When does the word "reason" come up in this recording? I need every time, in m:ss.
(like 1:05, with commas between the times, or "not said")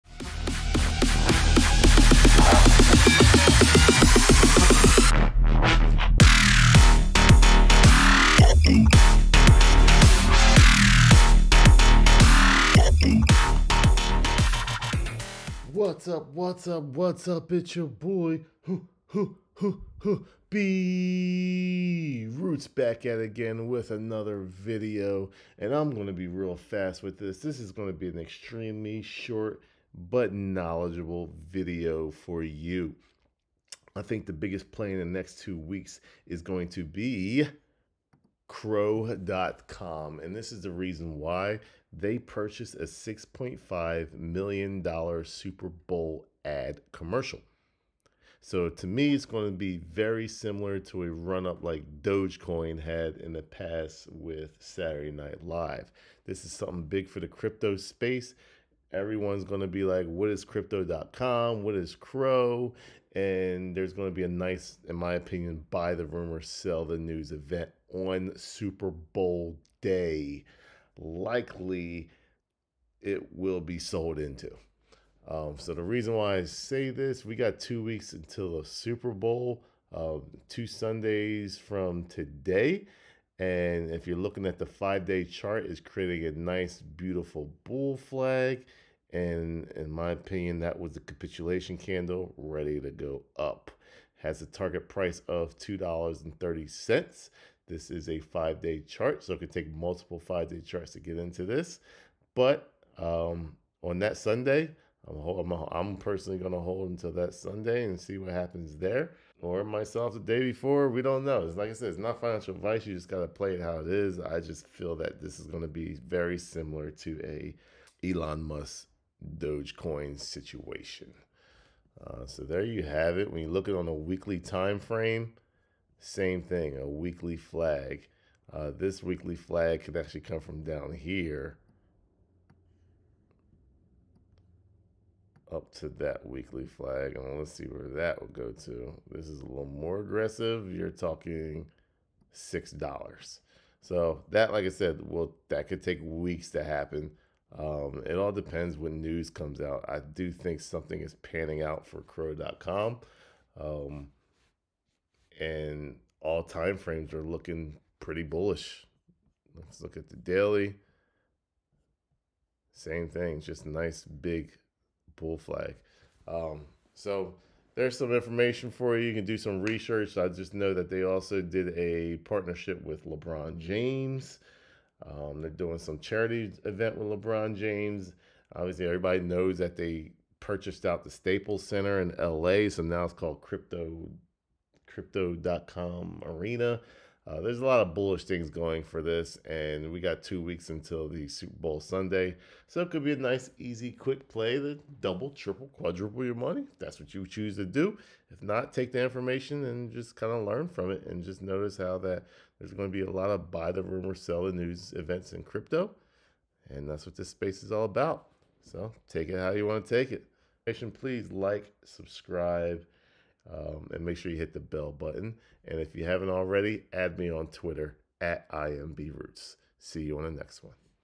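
0:40, 1:15.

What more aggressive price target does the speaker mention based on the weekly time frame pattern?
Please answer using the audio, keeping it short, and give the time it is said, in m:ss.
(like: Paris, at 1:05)
$6, at 2:22.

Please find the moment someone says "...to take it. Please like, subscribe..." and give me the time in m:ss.
3:29.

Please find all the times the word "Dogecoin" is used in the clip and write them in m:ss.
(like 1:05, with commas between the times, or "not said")
0:52, 1:59.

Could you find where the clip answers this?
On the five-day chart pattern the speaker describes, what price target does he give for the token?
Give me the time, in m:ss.
1:35.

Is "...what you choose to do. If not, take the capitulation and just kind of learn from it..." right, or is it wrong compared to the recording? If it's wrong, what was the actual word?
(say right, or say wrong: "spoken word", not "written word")
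wrong: "information", not "capitulation".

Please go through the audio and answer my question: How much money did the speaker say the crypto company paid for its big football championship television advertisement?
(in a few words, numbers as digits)
$6.5 million.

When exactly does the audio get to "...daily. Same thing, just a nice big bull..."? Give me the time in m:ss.
2:40.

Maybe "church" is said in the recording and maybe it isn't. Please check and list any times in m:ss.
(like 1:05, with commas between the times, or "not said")
not said.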